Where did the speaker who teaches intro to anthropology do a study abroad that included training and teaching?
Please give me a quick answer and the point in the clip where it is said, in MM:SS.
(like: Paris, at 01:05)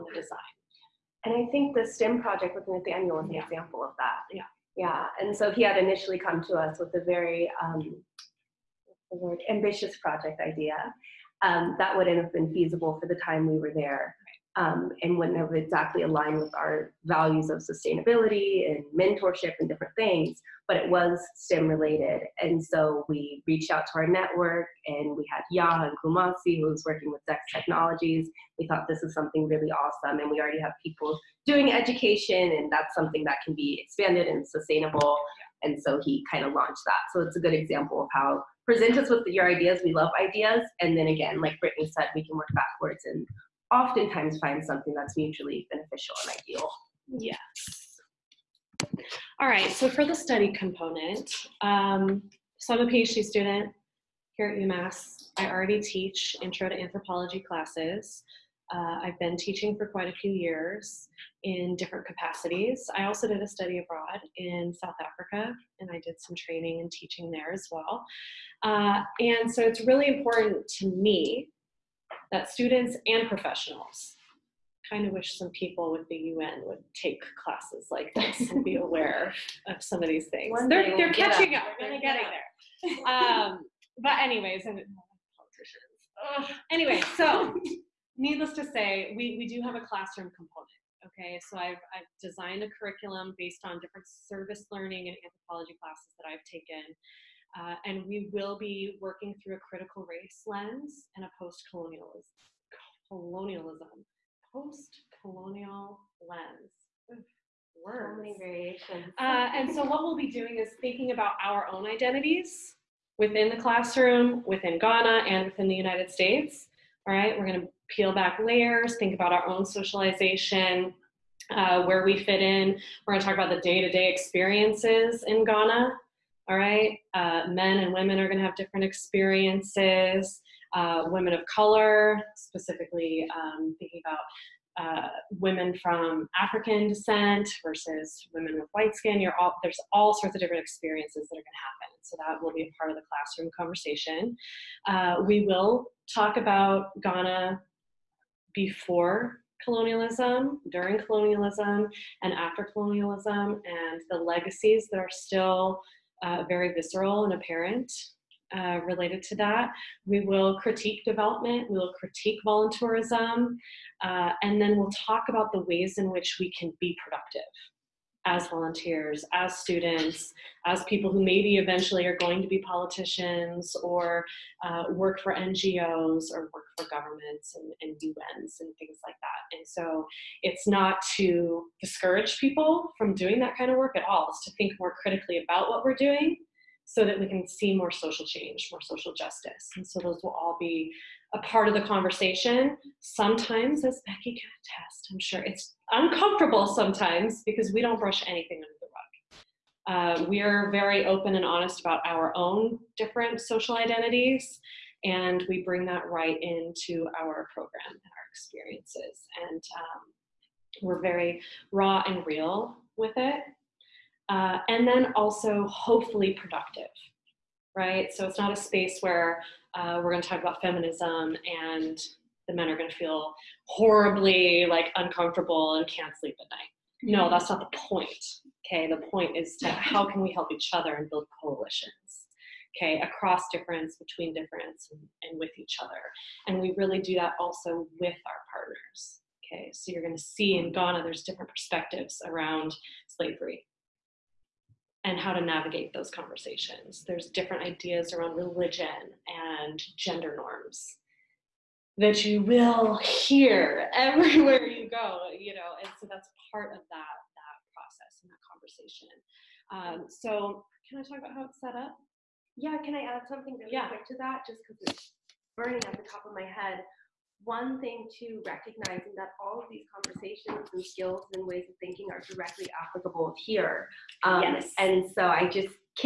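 South Africa, at 01:04.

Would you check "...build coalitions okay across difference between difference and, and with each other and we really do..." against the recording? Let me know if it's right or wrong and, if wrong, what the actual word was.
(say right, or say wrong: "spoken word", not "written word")
right.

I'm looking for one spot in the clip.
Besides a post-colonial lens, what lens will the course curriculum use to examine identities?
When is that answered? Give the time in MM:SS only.
01:39.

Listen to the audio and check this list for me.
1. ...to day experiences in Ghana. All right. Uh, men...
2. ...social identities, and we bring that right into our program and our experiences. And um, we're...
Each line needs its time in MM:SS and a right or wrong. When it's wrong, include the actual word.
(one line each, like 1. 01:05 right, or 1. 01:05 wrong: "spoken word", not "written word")
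1. 02:03 right
2. 03:23 right.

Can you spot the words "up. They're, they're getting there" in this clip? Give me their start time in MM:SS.
01:21.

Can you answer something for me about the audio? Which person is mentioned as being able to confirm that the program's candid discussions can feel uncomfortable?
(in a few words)
Becky.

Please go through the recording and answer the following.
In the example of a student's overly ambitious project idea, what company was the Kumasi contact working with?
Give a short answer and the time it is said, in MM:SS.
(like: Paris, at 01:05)
Dex Technologies, at 00:27.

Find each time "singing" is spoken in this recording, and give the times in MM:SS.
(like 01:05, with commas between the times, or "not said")
not said.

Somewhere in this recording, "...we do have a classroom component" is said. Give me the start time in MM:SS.
01:29.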